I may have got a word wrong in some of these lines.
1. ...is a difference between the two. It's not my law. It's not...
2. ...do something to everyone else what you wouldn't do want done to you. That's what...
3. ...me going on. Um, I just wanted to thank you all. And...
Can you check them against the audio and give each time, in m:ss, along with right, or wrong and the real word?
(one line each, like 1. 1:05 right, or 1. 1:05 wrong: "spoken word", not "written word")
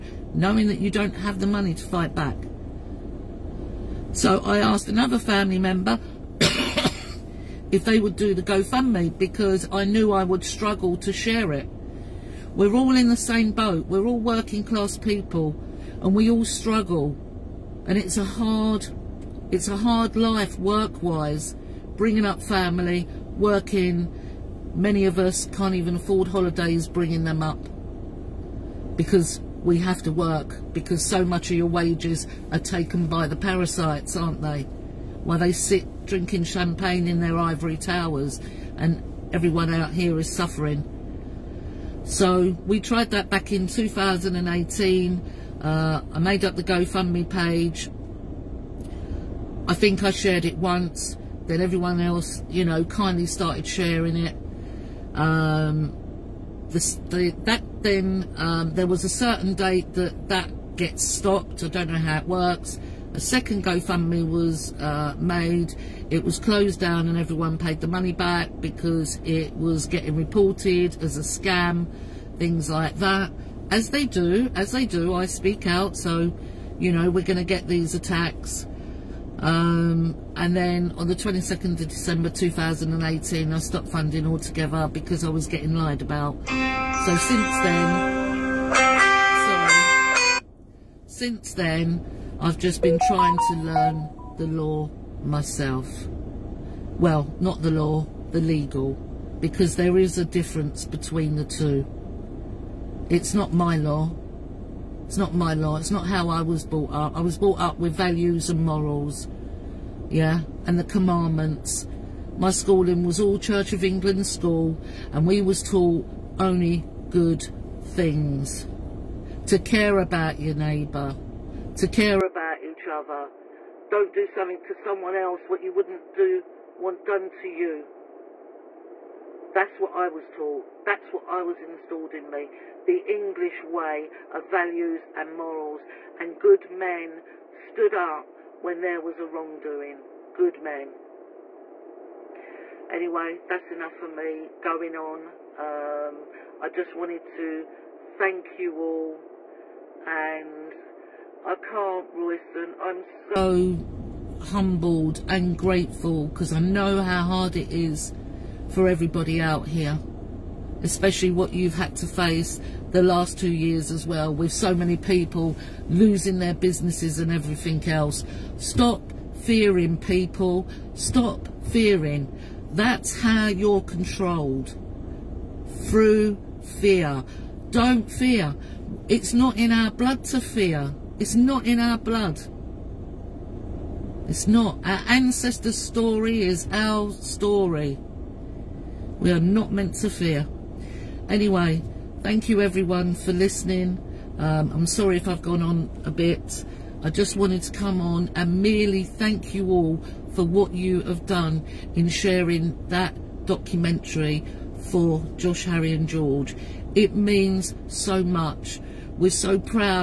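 1. 1:39 right
2. 2:04 wrong: "someone", not "everyone"
3. 2:24 right.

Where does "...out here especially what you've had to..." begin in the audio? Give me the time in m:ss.
2:39.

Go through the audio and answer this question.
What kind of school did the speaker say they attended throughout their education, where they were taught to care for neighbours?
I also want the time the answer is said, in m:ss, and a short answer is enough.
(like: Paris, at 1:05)
Church of England school, at 1:53.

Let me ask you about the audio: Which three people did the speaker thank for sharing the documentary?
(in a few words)
Josh, Harry and George.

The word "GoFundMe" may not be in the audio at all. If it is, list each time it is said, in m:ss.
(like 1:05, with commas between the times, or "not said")
0:08, 0:46, 1:03.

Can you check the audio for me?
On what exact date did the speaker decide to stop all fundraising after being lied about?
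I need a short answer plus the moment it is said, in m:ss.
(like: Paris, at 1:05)
22 December 2018, at 1:21.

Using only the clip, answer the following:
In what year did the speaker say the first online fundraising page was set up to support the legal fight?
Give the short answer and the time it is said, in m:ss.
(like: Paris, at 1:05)
2018, at 0:43.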